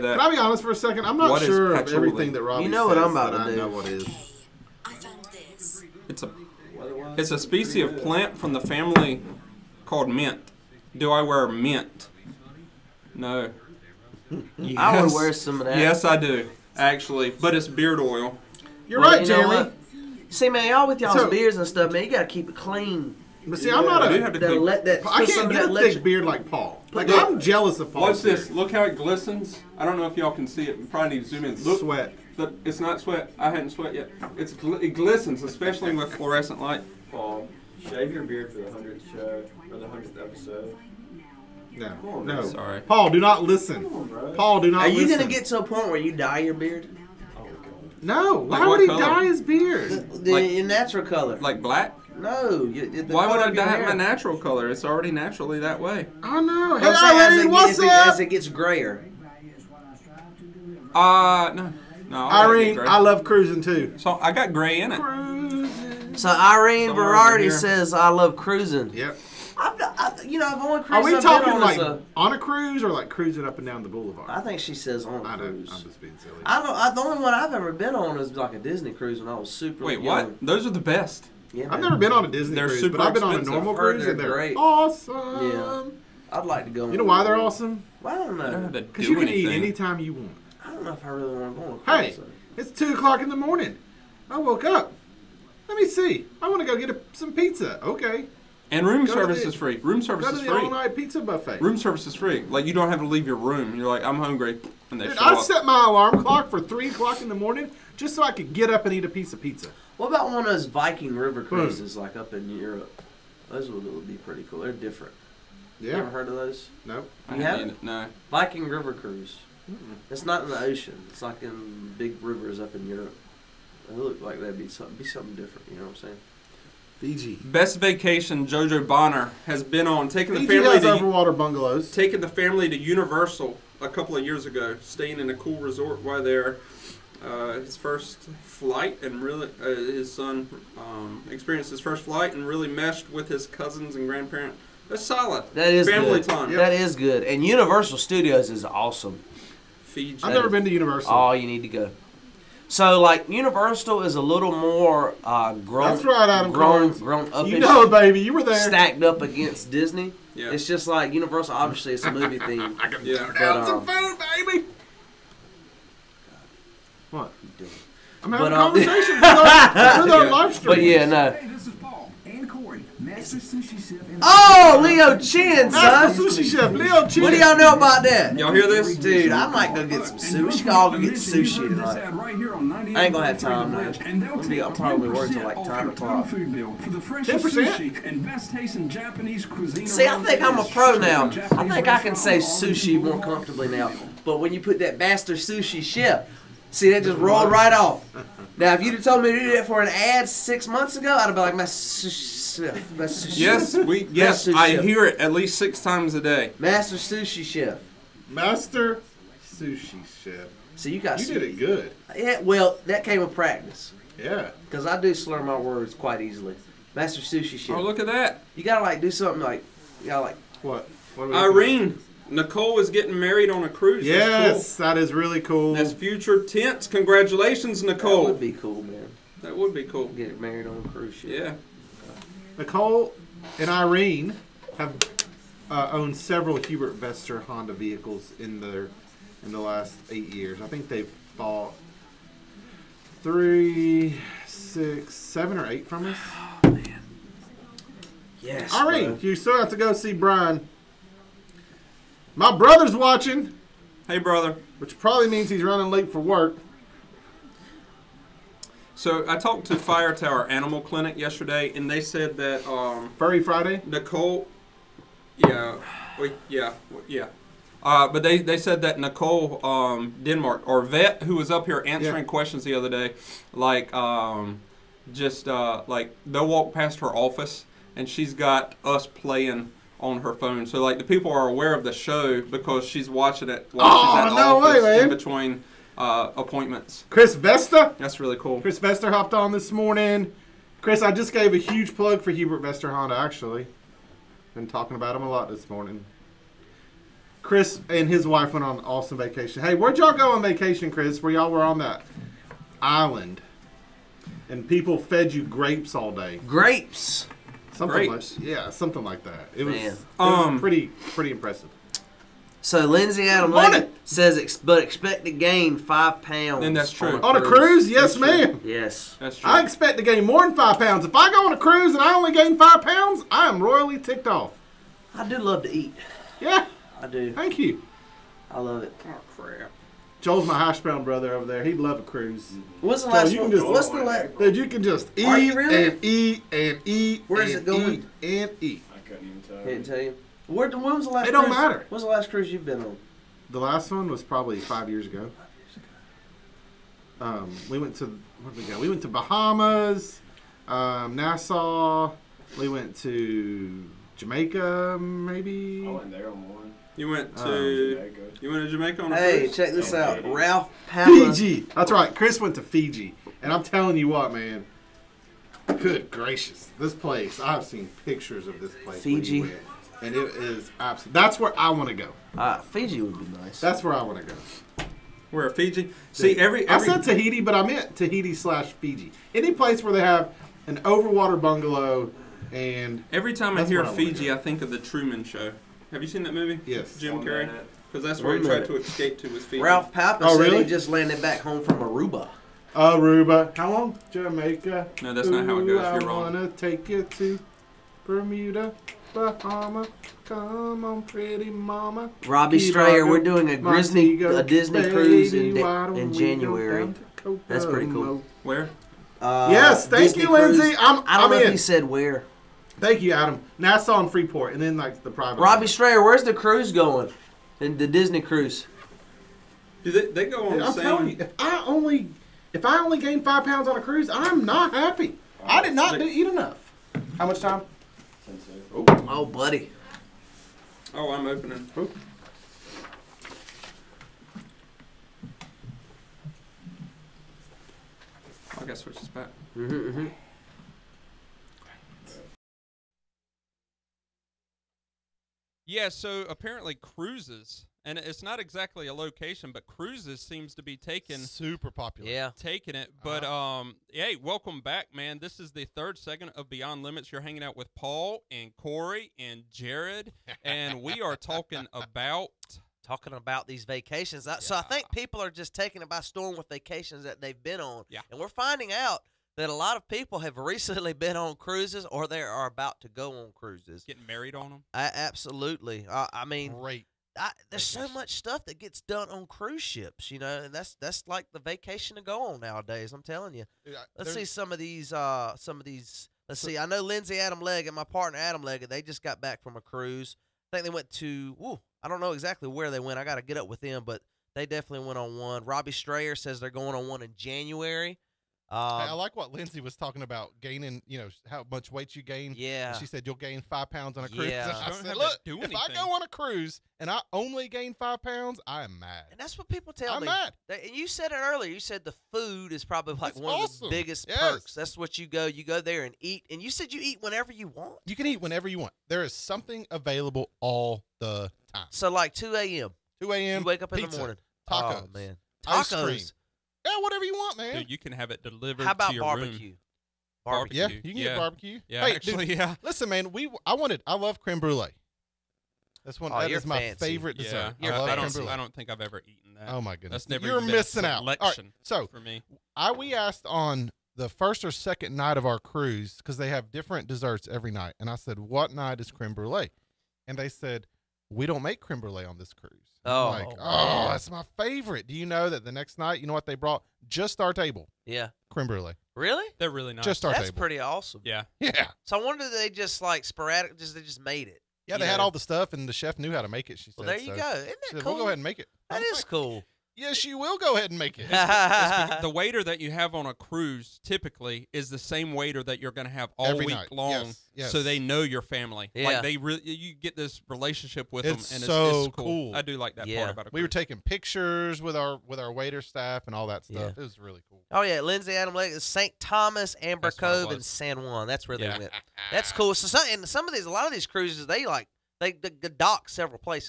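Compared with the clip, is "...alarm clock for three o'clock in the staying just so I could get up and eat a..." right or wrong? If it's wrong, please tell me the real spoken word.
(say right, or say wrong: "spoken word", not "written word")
wrong: "morning", not "staying".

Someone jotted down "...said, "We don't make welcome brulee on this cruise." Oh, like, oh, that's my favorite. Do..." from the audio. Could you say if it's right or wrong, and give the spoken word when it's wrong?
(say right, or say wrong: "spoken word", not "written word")
wrong: "creme", not "welcome".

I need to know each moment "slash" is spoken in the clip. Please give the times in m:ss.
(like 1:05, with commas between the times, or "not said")
6:18.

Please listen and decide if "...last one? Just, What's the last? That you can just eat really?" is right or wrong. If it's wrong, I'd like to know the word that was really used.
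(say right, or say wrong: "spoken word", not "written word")
right.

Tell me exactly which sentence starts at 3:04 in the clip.
I'm probably working like 10 o'clock.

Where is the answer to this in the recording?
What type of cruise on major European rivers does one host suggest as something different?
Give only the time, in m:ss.
1:58.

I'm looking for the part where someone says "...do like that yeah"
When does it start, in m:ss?
9:42.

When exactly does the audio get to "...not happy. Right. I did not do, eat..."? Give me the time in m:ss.
7:04.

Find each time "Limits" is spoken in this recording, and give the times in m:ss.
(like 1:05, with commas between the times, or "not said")
7:36.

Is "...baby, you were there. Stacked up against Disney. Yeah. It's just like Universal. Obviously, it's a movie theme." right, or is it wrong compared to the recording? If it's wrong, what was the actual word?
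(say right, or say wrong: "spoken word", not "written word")
right.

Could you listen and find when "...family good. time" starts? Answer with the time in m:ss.
2:25.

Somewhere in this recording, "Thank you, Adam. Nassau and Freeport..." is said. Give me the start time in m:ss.
6:52.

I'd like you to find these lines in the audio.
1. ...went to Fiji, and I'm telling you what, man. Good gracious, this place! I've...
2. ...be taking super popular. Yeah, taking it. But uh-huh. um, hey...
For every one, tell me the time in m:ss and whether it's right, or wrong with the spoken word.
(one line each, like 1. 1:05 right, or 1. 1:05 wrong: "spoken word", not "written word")
1. 6:02 right
2. 7:30 right.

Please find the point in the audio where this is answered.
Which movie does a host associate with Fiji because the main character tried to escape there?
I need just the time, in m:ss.
6:24.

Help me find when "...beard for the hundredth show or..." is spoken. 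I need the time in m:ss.
0:38.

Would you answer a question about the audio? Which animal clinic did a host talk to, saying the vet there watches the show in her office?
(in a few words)
Fire Tower Animal Clinic.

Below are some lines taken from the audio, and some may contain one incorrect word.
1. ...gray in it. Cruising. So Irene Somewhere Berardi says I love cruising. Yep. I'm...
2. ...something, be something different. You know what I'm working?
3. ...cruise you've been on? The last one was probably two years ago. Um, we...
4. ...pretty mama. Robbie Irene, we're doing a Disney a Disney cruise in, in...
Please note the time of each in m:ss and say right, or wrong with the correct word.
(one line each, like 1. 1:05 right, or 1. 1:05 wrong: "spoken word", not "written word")
1. 1:04 right
2. 2:04 wrong: "saying", not "working"
3. 5:42 wrong: "five", not "two"
4. 6:41 wrong: "Strayer", not "Irene".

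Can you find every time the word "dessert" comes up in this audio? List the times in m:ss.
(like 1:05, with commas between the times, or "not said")
8:57, 9:06.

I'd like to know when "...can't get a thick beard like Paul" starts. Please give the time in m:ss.
0:25.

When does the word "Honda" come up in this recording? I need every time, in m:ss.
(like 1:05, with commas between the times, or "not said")
3:57, 4:52.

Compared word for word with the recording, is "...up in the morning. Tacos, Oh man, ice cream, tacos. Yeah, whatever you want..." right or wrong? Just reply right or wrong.
right.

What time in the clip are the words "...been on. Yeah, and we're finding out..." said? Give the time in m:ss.
7:47.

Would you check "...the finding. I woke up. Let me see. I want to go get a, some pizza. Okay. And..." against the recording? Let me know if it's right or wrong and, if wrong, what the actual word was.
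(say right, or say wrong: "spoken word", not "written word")
wrong: "morning", not "finding".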